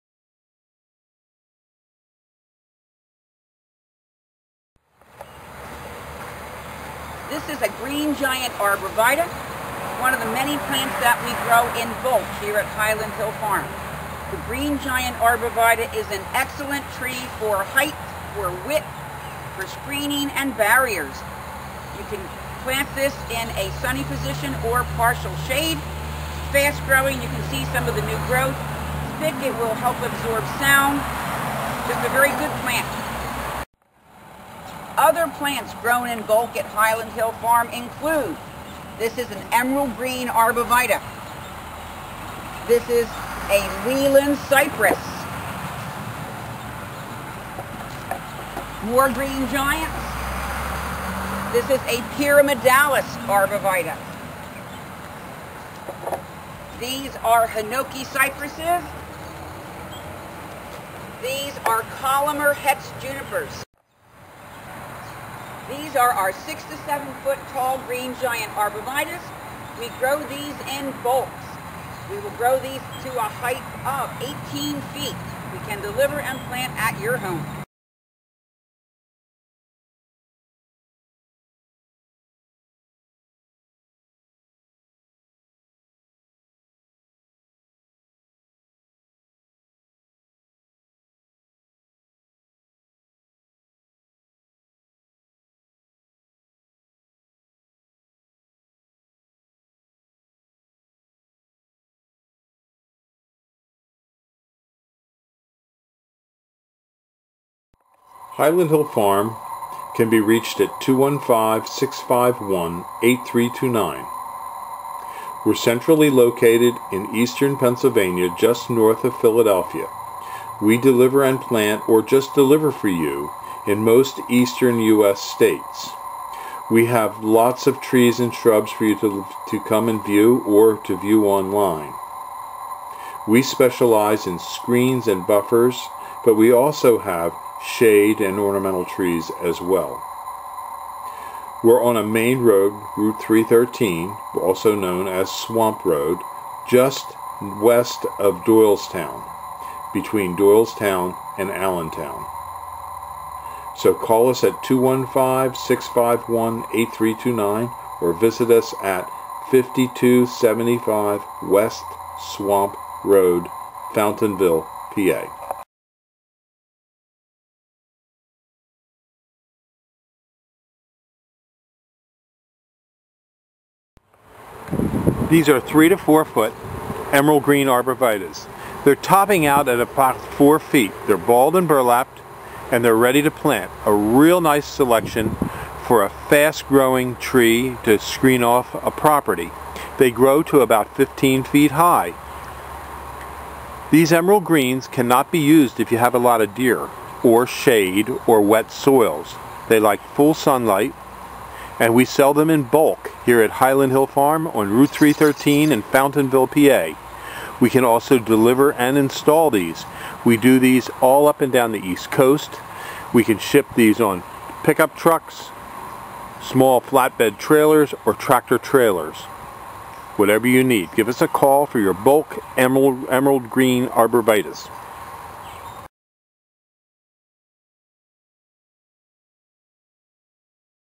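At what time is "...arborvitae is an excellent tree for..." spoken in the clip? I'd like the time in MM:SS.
00:15.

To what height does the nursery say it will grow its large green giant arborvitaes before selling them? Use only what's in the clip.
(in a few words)
18 feet.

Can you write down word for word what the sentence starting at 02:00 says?
We deliver and plant or just deliver for you in most eastern U.S.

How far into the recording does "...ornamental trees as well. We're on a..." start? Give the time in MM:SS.
02:18.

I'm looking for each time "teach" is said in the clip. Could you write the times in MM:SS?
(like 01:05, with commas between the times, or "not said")
not said.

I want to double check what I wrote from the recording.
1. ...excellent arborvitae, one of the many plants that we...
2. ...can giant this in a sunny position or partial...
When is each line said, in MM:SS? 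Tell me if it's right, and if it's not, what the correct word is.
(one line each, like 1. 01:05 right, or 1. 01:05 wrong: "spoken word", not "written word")
1. 00:08 wrong: "giant", not "excellent"
2. 00:22 wrong: "plant", not "giant".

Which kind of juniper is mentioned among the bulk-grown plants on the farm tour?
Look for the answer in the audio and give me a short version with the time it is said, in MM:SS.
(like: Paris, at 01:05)
Columnar Hetz junipers, at 01:02.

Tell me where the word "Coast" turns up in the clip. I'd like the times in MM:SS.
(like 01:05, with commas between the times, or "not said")
03:32.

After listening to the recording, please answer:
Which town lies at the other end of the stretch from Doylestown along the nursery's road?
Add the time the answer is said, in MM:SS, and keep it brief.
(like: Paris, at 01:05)
Allentown, at 02:31.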